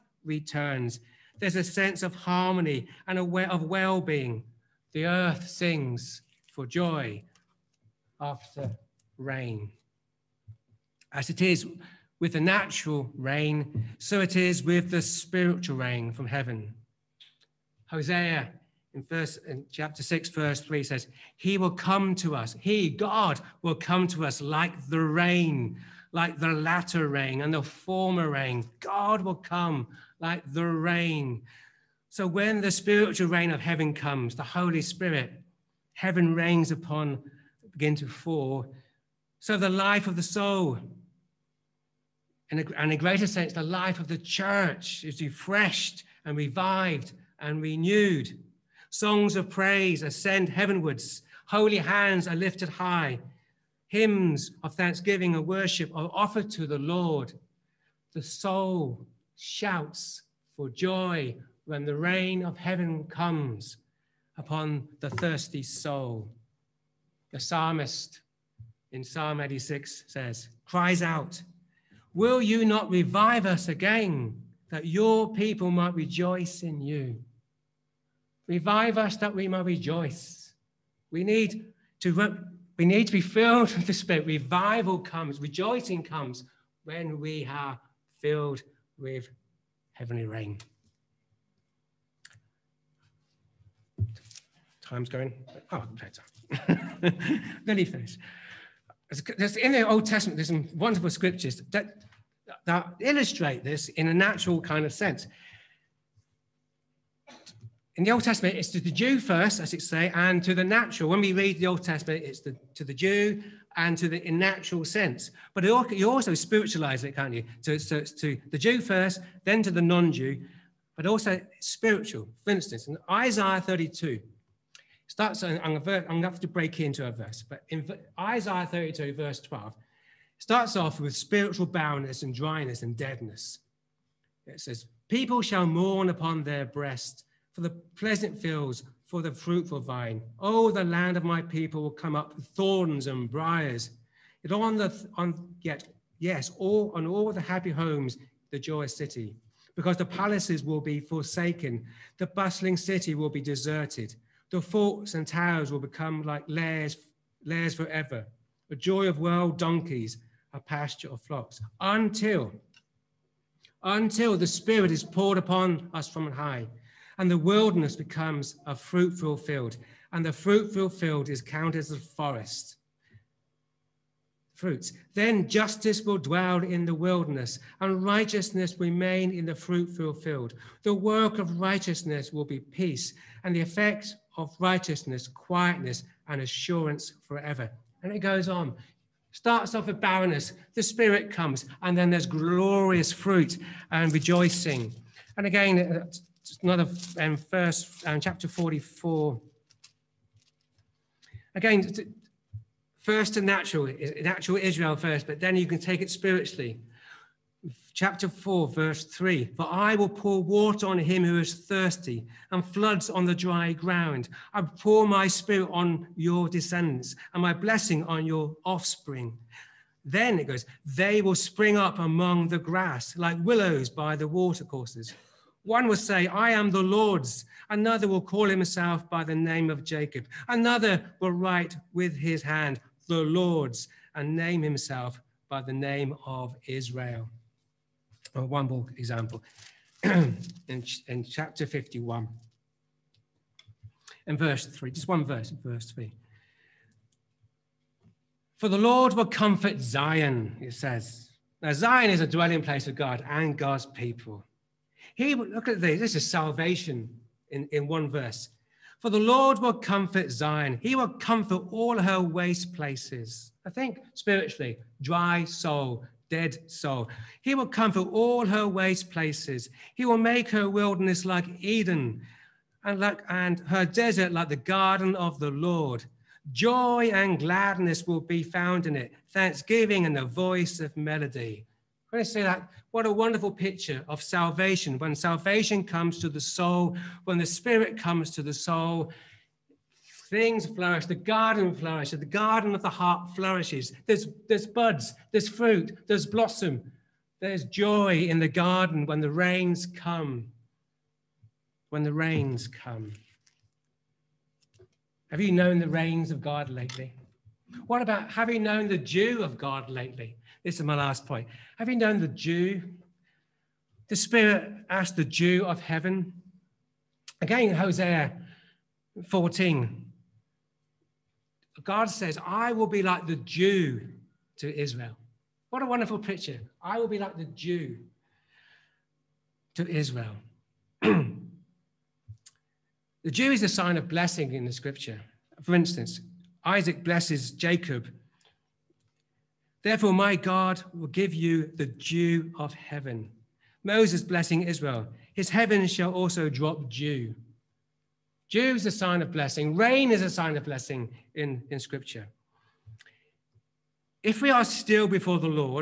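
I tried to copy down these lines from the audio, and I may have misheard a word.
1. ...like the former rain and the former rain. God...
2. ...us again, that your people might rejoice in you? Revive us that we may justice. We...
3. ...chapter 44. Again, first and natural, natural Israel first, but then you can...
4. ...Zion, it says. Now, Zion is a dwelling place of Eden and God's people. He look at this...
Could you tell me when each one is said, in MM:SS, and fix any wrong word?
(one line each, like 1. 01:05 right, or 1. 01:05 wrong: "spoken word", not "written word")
1. 00:26 wrong: "latter", not "former"
2. 01:13 wrong: "rejoice", not "justice"
3. 03:18 right
4. 04:09 wrong: "God", not "Eden".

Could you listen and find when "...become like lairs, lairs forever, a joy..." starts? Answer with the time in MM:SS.
02:35.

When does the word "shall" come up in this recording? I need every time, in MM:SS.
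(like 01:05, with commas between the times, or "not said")
02:15, 05:45.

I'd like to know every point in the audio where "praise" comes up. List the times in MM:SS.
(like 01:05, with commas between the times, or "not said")
00:49.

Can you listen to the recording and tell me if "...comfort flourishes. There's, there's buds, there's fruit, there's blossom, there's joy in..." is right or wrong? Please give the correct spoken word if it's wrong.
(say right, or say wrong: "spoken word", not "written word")
wrong: "heart", not "comfort".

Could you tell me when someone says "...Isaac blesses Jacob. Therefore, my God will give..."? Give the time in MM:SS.
05:36.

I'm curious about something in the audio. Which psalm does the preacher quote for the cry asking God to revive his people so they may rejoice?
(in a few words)
Psalm 86.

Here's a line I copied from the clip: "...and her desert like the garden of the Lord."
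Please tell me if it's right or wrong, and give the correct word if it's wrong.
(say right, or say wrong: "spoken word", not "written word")
right.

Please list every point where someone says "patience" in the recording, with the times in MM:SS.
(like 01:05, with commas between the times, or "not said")
not said.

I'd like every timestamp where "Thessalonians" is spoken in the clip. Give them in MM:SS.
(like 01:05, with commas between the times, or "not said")
not said.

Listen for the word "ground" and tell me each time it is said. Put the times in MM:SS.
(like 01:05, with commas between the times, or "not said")
03:33.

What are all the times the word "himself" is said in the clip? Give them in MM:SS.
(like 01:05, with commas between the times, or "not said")
03:48, 03:54.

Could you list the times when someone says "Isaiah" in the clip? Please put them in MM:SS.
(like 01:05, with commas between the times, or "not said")
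02:03, 02:08.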